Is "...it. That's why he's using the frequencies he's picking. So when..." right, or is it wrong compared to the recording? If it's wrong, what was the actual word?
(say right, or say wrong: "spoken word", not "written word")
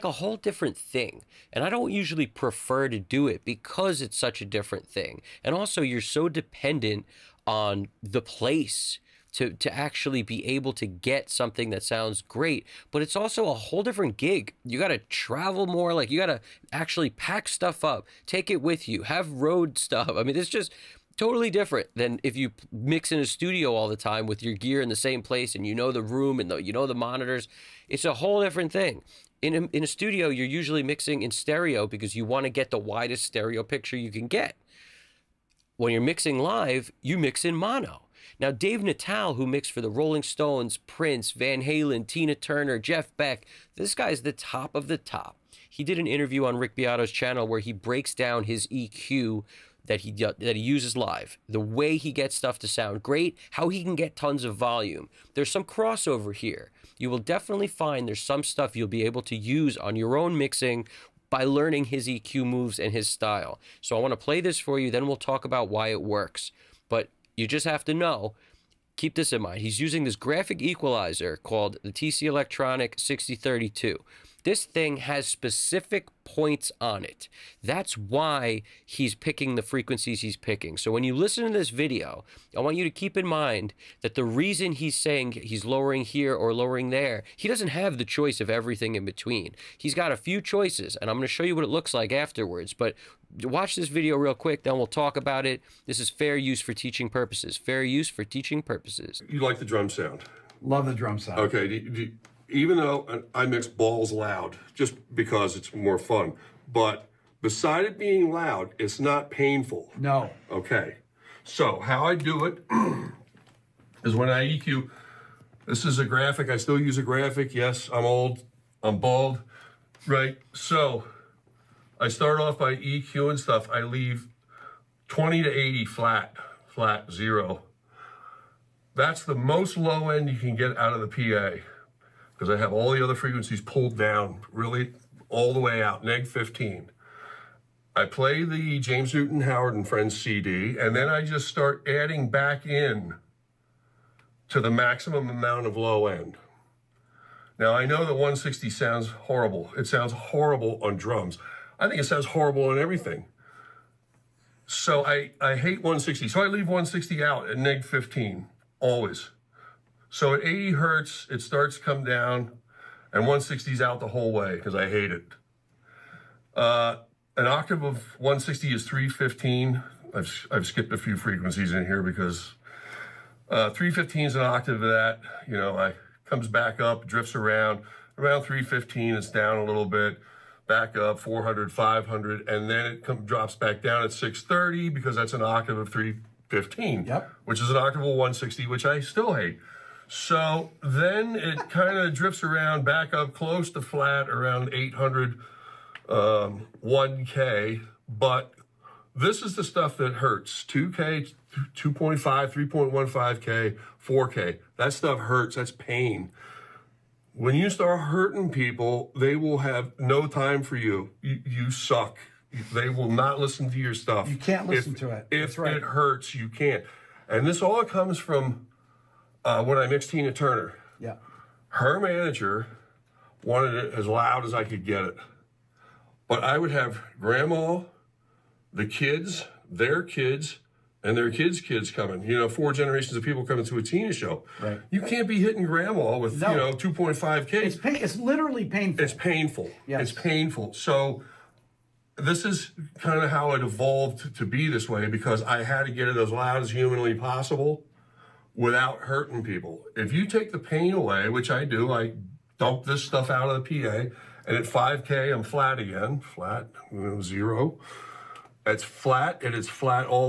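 wrong: "picking", not "using".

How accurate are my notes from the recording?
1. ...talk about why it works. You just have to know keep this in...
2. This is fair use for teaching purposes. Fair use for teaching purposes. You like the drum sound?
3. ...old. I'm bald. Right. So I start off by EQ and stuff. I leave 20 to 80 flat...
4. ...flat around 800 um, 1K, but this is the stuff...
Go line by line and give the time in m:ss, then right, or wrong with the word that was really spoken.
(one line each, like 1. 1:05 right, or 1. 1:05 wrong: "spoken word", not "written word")
1. 1:05 right
2. 1:35 right
3. 1:58 right
4. 3:13 right.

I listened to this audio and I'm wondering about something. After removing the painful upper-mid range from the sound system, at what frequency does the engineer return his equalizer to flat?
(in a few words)
5K.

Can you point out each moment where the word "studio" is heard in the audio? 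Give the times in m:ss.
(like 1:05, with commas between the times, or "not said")
0:23, 0:29.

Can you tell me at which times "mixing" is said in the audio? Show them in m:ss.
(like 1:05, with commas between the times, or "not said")
0:30, 0:36, 1:00.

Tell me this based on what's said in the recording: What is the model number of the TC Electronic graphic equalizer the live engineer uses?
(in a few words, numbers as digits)
6032.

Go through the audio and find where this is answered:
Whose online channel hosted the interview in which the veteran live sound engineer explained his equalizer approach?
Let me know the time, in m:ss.
0:46.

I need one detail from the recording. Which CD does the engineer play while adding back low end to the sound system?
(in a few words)
James Newton Howard and Friends.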